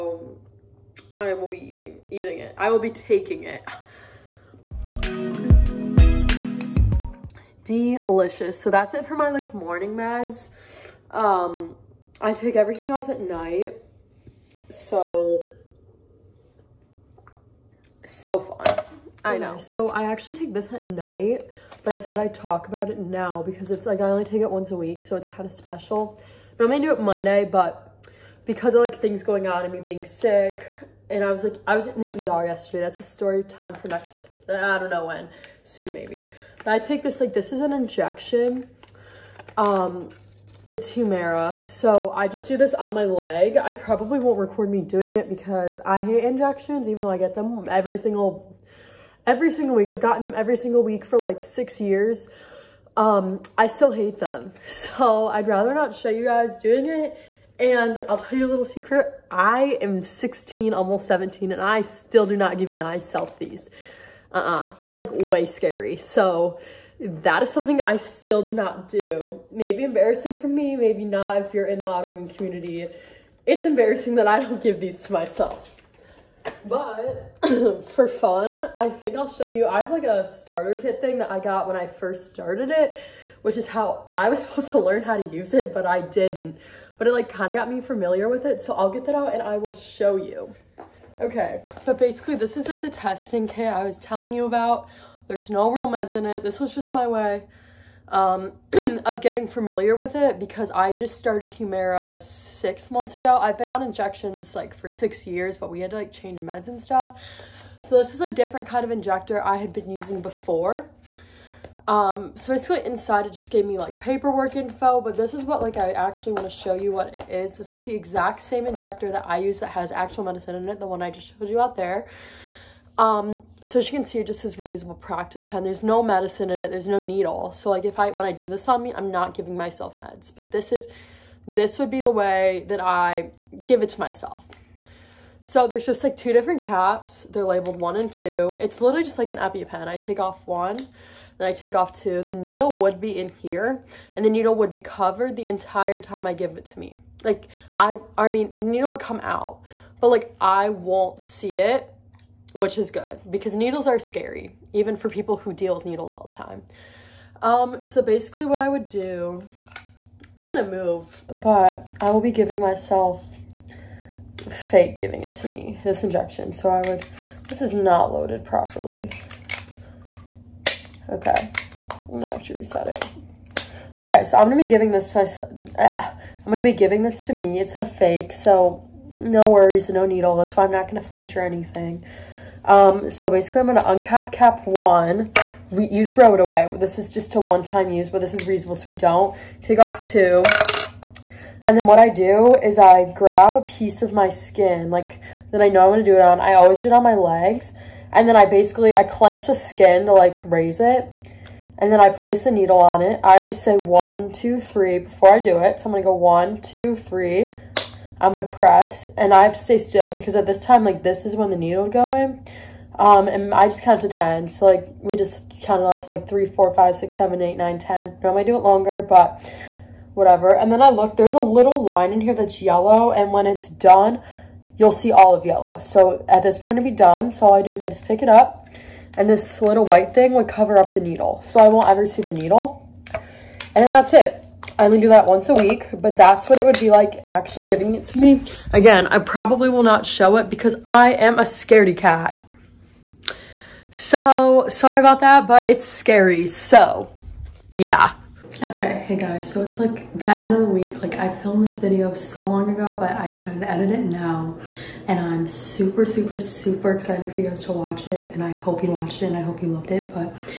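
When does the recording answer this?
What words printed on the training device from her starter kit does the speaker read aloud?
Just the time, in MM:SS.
02:04.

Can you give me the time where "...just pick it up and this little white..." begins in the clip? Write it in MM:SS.
03:47.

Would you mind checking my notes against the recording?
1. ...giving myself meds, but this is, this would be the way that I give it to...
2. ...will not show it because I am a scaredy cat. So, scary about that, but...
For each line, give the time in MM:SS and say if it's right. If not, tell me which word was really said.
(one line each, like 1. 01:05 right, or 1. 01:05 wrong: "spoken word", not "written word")
1. 02:09 right
2. 03:59 wrong: "sorry", not "scary".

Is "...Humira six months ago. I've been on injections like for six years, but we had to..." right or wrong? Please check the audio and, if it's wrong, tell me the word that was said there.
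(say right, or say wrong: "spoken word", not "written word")
right.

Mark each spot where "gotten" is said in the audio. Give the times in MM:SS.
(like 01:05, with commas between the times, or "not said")
00:49.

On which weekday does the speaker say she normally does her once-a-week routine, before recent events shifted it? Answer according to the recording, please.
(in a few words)
Monday.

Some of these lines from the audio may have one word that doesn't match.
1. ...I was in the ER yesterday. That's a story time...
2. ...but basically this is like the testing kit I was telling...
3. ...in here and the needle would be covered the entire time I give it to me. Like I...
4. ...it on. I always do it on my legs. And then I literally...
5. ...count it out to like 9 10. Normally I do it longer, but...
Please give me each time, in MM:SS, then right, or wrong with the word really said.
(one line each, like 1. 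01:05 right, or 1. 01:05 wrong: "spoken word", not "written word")
1. 00:31 right
2. 01:31 right
3. 02:23 right
4. 03:16 wrong: "basically", not "literally"
5. 03:35 right.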